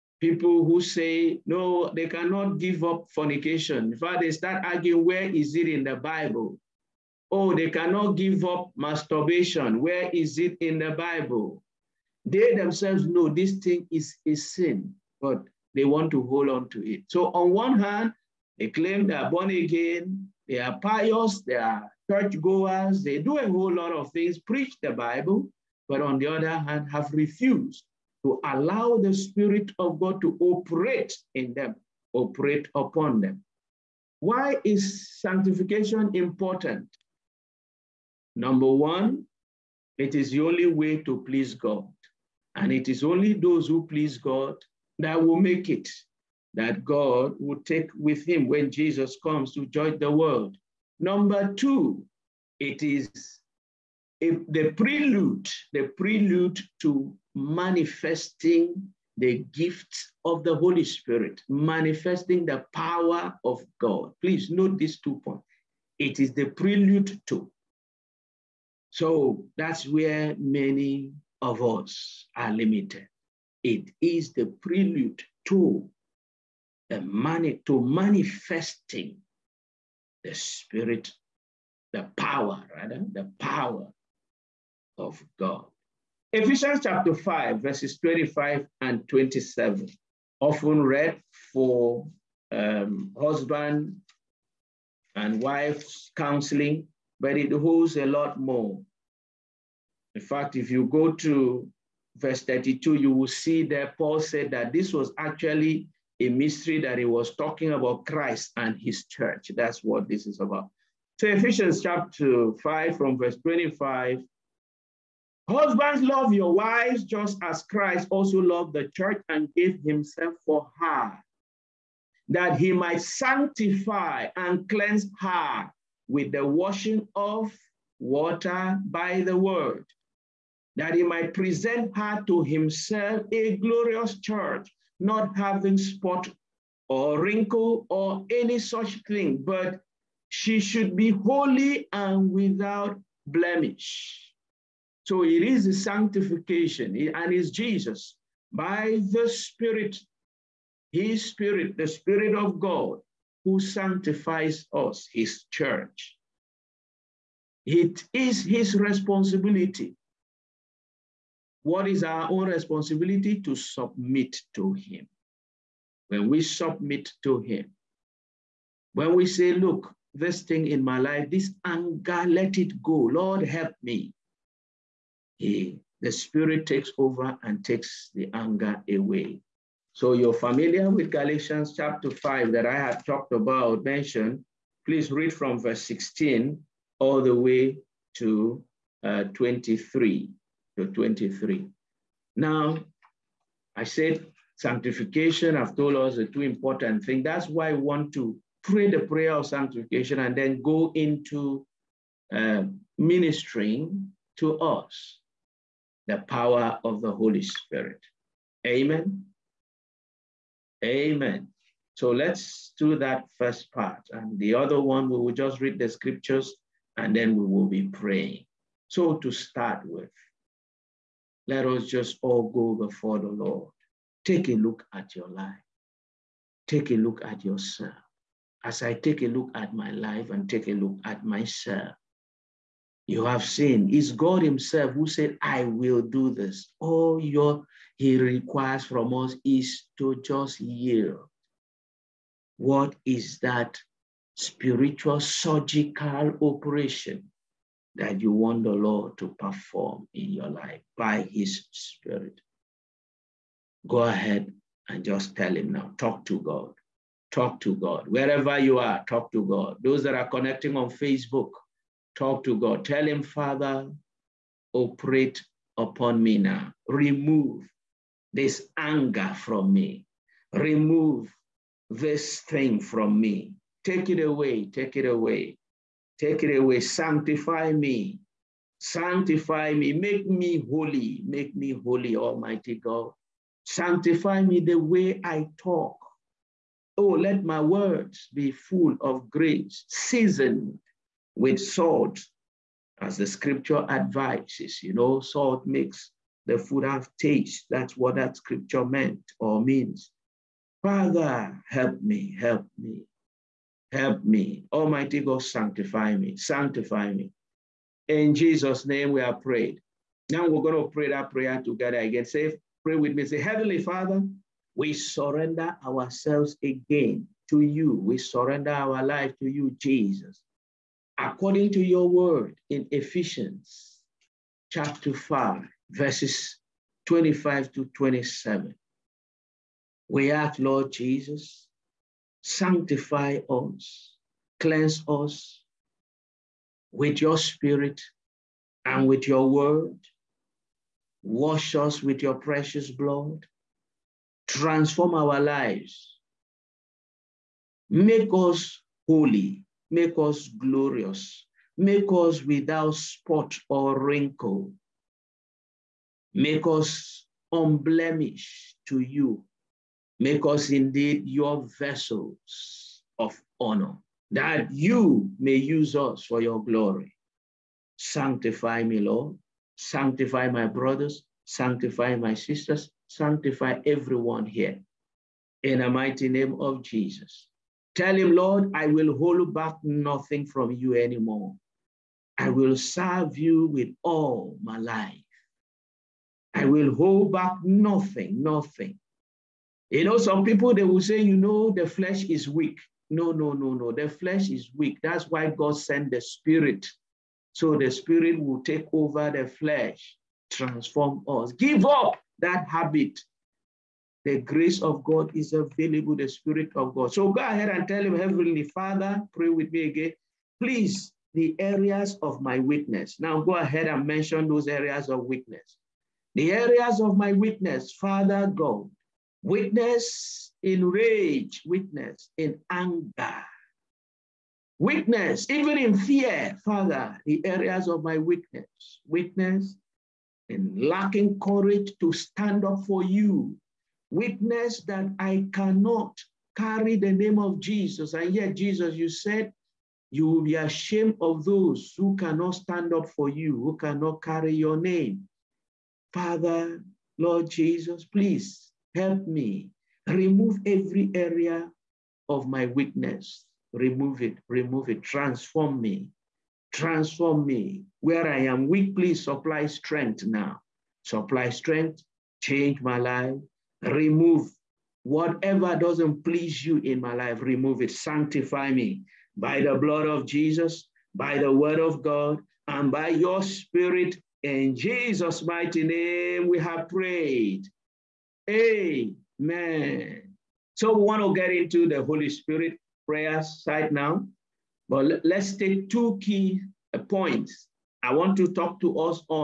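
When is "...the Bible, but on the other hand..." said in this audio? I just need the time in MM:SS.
00:24.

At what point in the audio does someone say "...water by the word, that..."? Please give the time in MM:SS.
02:07.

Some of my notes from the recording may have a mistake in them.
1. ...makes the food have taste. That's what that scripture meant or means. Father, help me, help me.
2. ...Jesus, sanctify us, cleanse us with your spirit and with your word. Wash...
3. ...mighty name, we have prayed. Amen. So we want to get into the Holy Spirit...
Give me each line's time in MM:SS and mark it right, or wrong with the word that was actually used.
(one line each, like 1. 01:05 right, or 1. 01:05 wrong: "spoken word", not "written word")
1. 04:55 right
2. 05:30 right
3. 07:55 right.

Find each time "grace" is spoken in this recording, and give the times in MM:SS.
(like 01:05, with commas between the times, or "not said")
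04:49, 06:44.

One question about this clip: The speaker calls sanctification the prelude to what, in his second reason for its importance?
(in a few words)
manifesting the gifts of the Holy Spirit.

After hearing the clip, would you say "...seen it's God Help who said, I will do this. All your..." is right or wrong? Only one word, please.
wrong.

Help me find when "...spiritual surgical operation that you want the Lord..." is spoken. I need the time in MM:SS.
04:04.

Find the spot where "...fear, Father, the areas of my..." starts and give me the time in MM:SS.
07:05.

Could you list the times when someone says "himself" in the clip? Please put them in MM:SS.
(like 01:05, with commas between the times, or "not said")
01:59, 02:12, 03:54.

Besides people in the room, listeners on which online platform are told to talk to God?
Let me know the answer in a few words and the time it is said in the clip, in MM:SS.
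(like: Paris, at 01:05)
Facebook, at 04:20.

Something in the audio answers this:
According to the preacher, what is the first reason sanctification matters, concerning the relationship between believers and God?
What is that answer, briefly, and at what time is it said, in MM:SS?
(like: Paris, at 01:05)
the only way to please God, at 00:39.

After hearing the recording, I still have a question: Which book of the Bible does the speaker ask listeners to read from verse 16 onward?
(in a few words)
Galatians.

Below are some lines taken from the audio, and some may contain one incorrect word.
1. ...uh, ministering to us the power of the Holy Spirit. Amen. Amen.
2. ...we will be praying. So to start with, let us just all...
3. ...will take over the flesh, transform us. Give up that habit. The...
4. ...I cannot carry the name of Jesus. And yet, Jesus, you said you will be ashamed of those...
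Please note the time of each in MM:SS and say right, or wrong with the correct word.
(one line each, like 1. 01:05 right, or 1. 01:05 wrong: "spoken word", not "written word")
1. 03:22 right
2. 03:37 right
3. 06:38 right
4. 07:15 right.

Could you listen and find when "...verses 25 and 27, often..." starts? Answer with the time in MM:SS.
01:27.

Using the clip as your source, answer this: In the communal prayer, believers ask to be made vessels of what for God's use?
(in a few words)
honor.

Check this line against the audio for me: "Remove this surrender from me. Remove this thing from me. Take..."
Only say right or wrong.
wrong.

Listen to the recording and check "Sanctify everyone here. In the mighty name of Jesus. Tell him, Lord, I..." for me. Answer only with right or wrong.
right.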